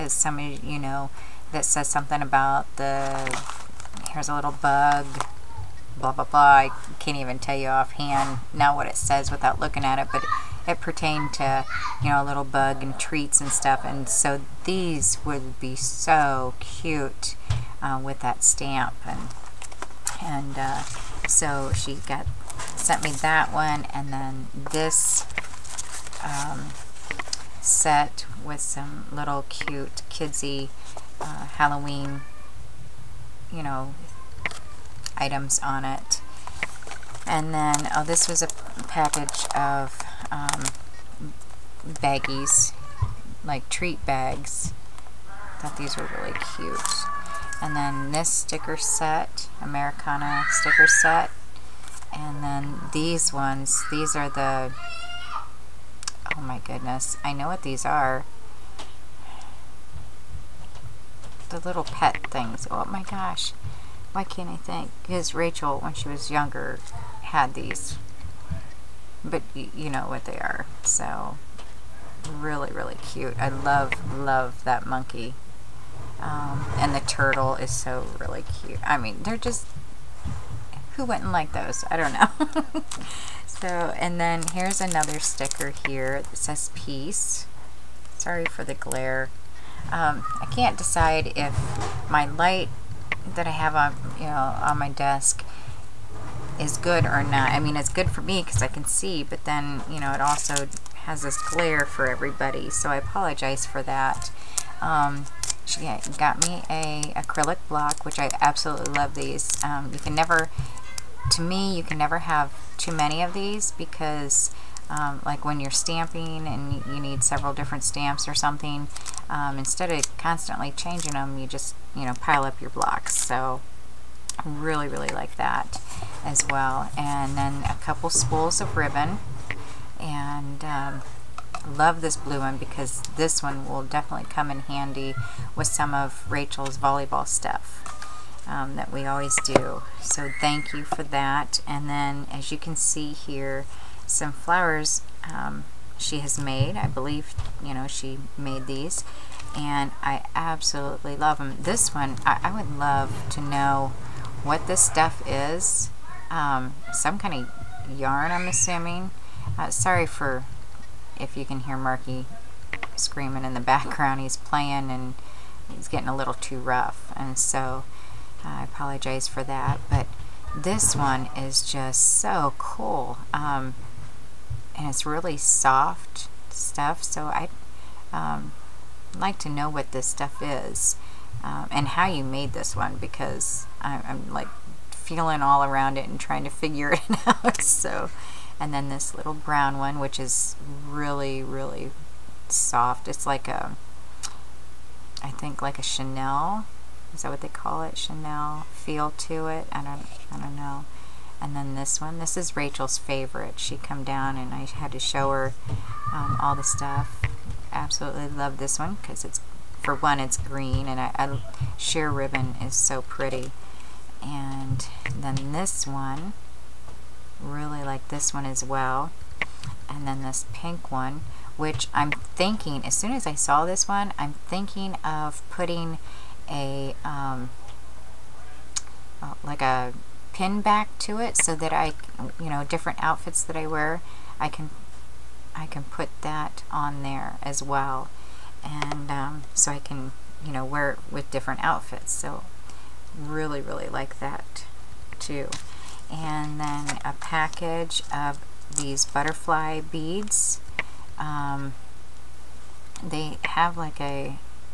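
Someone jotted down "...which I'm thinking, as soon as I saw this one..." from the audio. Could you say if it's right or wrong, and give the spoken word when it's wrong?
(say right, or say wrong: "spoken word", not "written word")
right.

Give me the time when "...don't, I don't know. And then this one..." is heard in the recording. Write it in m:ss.
3:19.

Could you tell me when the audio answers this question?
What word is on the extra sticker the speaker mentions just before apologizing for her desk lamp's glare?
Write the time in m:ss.
1:26.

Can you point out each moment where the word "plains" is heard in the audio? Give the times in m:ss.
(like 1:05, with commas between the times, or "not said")
not said.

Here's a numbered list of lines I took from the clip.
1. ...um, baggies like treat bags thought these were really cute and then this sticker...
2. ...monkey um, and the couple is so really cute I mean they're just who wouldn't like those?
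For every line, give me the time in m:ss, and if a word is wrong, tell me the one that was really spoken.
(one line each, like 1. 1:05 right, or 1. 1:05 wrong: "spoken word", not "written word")
1. 0:40 right
2. 1:14 wrong: "turtle", not "couple".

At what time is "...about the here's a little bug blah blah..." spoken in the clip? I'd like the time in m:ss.
0:02.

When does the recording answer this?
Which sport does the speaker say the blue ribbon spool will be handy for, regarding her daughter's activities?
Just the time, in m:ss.
2:16.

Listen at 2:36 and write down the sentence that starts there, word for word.
Um, some kind of yarn, I'm assuming.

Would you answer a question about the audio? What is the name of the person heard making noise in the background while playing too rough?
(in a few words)
Marky.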